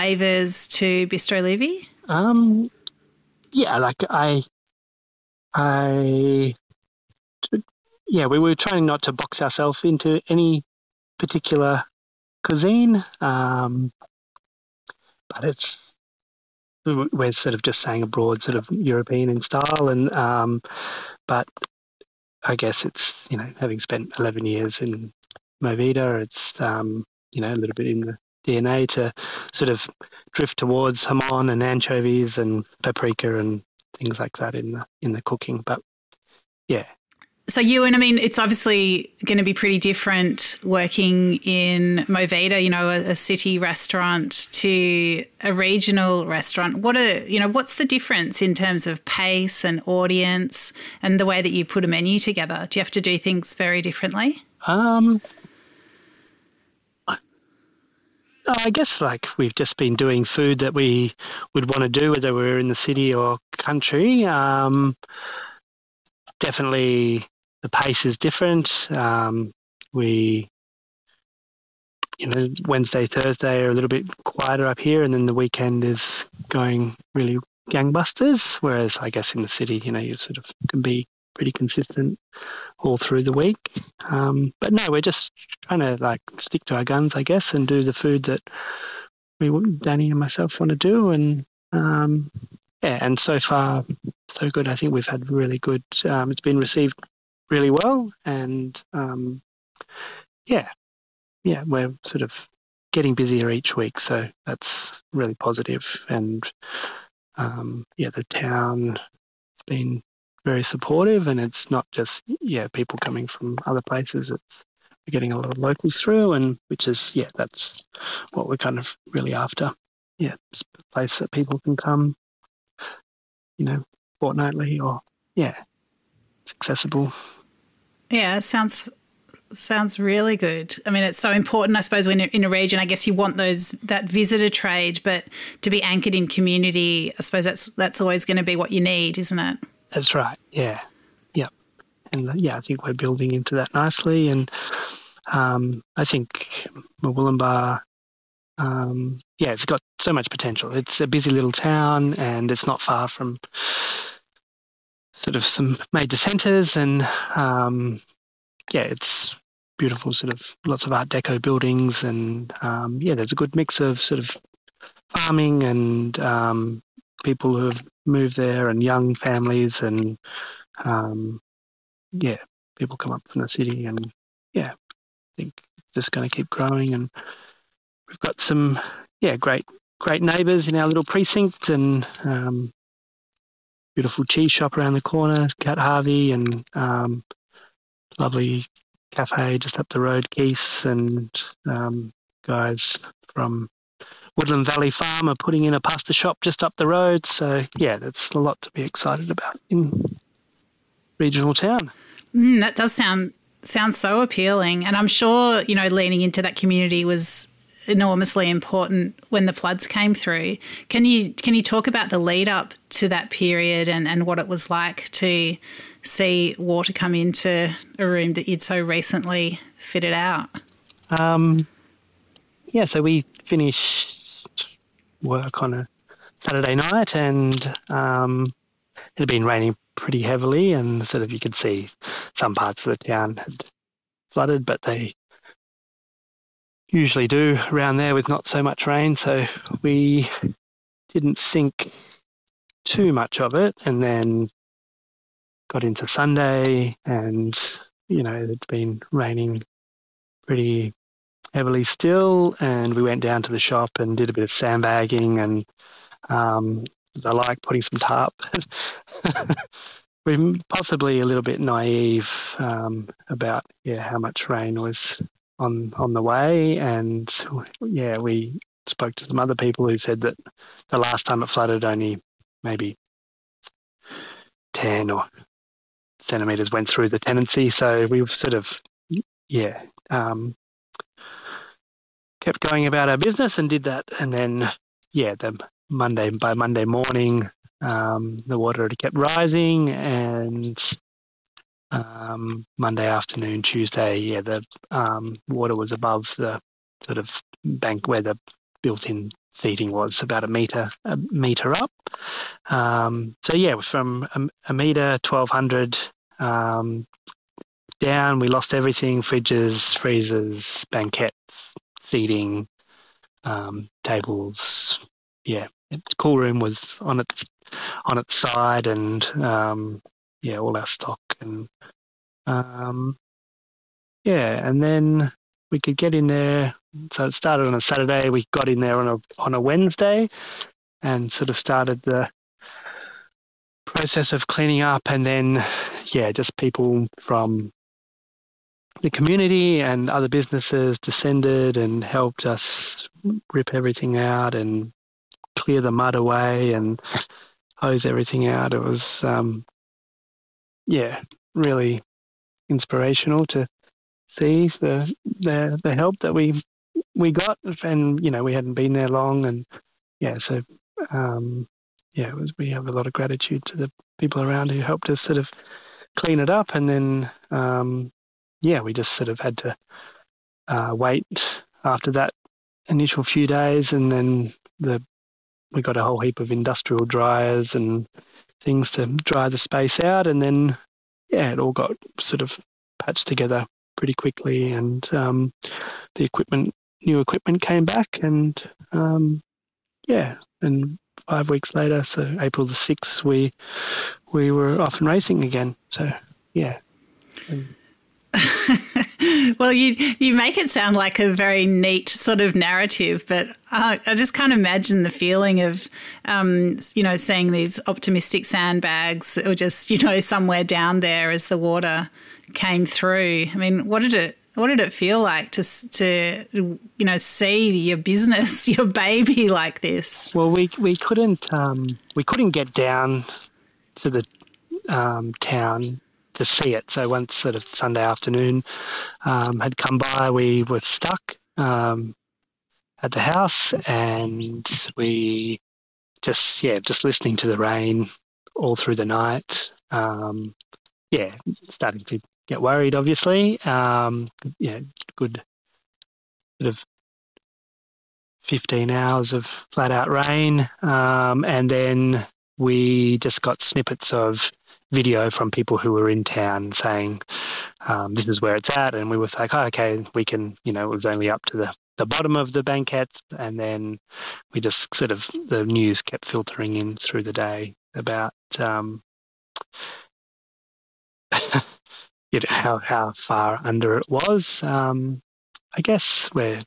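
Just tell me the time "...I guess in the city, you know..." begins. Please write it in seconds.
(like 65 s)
78 s.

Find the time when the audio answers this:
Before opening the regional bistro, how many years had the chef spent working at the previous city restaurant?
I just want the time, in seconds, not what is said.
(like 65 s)
24 s.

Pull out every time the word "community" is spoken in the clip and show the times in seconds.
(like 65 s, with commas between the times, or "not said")
136 s, 206 s, 339 s.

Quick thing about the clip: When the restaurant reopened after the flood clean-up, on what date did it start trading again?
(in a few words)
April 6.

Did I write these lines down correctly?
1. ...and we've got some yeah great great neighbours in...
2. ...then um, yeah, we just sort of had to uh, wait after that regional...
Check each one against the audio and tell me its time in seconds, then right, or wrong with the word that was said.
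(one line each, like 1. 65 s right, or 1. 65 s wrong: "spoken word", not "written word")
1. 176 s right
2. 366 s wrong: "initial", not "regional".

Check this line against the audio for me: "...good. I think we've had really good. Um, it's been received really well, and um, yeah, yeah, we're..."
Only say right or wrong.
right.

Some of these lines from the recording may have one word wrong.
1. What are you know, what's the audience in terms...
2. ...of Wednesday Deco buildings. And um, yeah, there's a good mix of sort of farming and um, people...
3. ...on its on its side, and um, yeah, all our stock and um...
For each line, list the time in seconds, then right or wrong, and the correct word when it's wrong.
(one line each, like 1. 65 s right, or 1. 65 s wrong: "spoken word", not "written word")
1. 46 s wrong: "difference", not "audience"
2. 160 s wrong: "Art", not "Wednesday"
3. 317 s right.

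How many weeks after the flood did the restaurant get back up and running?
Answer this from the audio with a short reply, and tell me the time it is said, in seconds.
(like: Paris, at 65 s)
5, at 391 s.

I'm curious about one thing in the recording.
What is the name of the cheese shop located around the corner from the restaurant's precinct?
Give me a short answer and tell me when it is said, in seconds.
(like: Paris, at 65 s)
Cat Harvey, at 185 s.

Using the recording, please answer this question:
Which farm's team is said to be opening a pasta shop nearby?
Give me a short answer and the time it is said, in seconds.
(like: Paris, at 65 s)
Woodland Valley Farm, at 194 s.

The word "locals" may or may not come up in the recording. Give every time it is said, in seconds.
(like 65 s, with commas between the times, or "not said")
115 s.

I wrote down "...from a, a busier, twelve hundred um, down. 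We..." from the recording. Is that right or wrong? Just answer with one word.
wrong.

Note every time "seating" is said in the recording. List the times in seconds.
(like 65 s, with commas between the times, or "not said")
299 s, 312 s.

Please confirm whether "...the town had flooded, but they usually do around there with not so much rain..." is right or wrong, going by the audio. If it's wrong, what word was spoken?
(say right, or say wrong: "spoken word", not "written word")
right.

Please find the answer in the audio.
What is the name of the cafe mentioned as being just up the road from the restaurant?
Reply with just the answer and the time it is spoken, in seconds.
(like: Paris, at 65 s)
Keith's, at 190 s.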